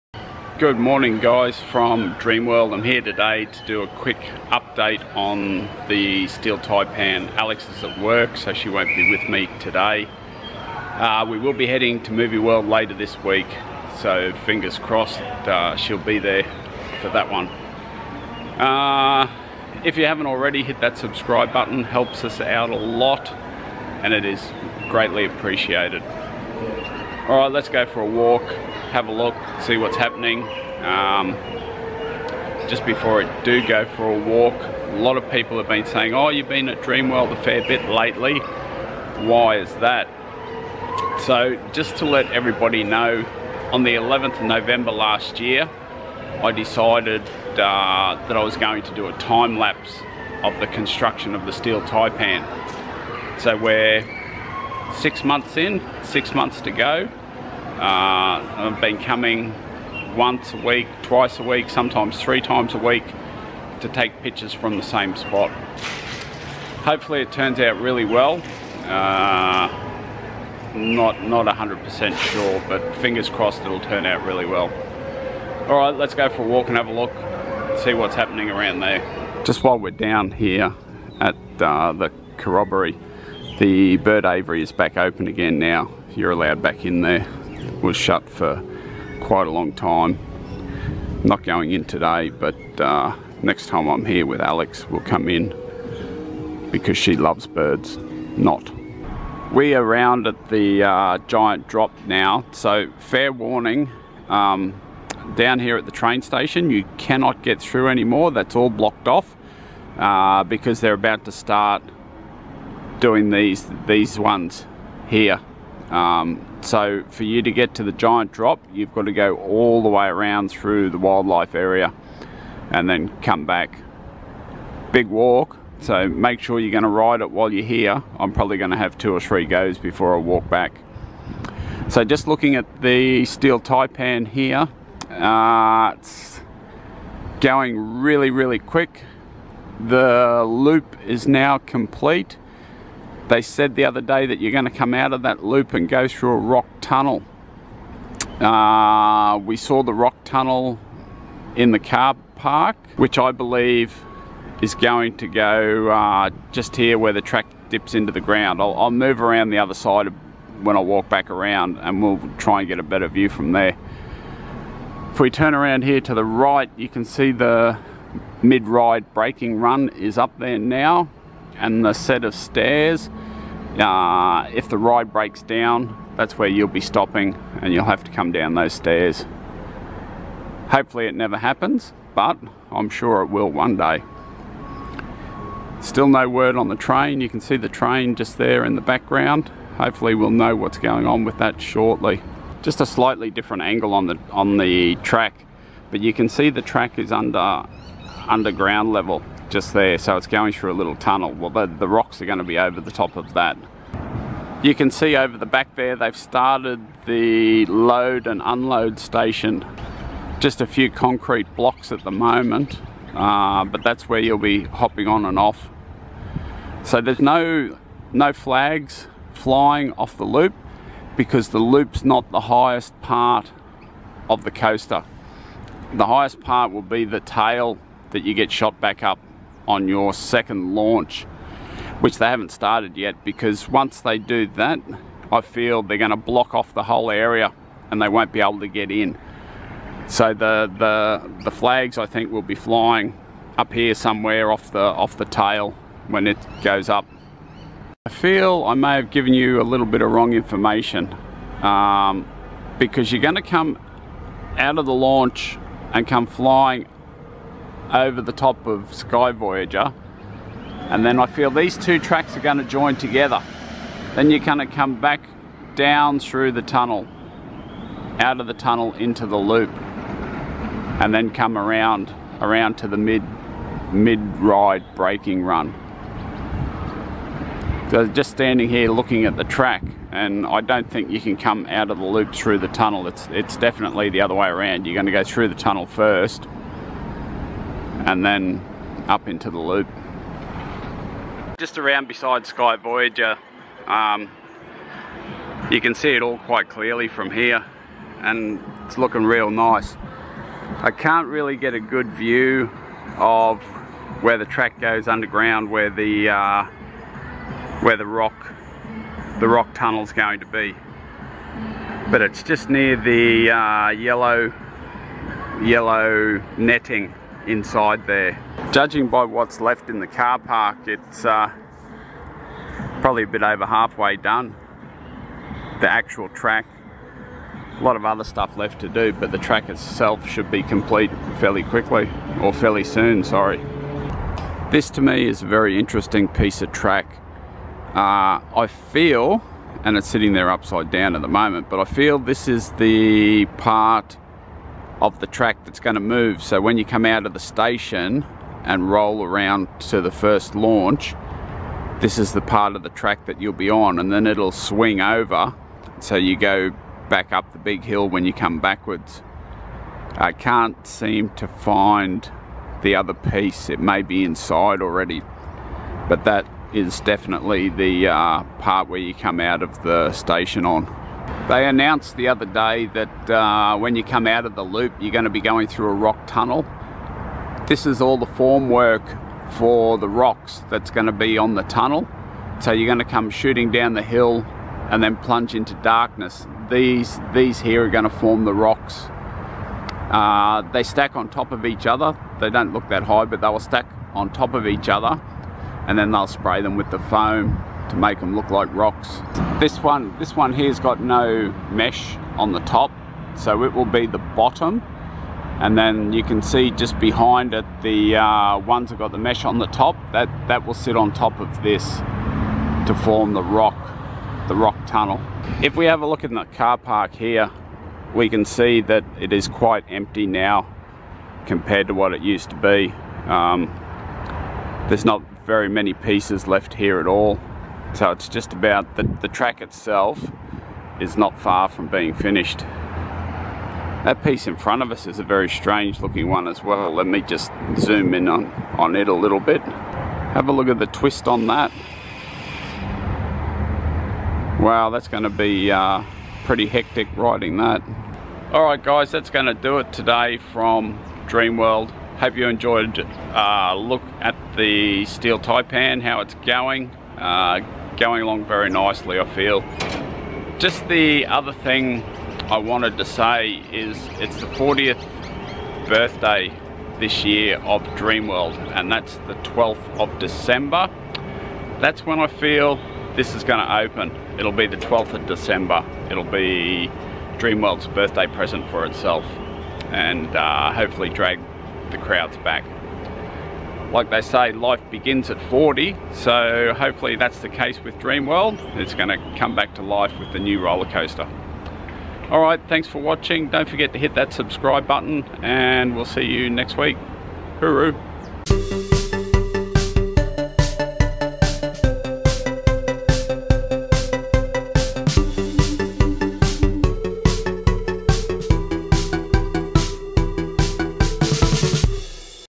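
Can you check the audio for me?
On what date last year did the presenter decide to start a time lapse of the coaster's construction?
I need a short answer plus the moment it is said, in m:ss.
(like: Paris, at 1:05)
11th of November, at 0:43.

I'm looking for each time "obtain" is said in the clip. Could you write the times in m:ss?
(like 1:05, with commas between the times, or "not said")
not said.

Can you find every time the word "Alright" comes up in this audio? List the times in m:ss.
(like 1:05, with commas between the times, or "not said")
0:26.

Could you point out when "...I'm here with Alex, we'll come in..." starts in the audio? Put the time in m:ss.
1:33.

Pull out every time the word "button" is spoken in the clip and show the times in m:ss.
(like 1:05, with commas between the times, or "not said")
0:21, 8:14.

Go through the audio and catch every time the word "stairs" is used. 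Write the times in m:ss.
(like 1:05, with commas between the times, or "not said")
2:52, 2:58.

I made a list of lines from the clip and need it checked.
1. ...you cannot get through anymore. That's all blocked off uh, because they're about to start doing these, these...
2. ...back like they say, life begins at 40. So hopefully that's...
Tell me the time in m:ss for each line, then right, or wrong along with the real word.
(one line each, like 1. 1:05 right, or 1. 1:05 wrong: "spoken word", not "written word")
1. 1:46 right
2. 8:02 right.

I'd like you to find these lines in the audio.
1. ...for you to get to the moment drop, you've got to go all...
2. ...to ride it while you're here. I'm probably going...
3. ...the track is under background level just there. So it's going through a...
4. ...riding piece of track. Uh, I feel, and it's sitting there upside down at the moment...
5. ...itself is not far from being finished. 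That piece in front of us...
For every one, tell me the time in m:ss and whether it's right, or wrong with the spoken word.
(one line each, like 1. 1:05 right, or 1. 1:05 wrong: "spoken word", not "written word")
1. 1:57 wrong: "giant", not "moment"
2. 2:06 right
3. 3:16 wrong: "underground", not "background"
4. 5:35 wrong: "interesting", not "riding"
5. 7:09 right.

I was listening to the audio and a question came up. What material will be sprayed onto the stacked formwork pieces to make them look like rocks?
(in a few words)
foam.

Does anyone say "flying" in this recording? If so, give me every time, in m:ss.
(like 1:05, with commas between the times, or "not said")
3:39, 4:02, 4:16.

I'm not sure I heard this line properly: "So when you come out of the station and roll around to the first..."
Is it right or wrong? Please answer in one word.
right.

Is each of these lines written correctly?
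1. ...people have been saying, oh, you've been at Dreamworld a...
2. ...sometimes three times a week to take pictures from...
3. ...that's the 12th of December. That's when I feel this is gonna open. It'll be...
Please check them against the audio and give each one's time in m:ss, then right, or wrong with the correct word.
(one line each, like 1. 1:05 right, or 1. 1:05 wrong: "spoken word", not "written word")
1. 0:35 right
2. 1:01 right
3. 7:48 right.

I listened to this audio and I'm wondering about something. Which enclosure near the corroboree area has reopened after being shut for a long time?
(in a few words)
bird aviary.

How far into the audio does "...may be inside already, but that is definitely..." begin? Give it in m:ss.
6:03.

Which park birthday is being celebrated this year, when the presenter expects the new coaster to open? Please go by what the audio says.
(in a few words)
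40th.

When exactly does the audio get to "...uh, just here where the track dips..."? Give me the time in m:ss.
2:35.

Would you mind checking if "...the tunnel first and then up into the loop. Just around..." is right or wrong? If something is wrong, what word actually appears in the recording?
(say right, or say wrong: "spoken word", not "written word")
right.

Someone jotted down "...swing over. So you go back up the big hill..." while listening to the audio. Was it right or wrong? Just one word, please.
right.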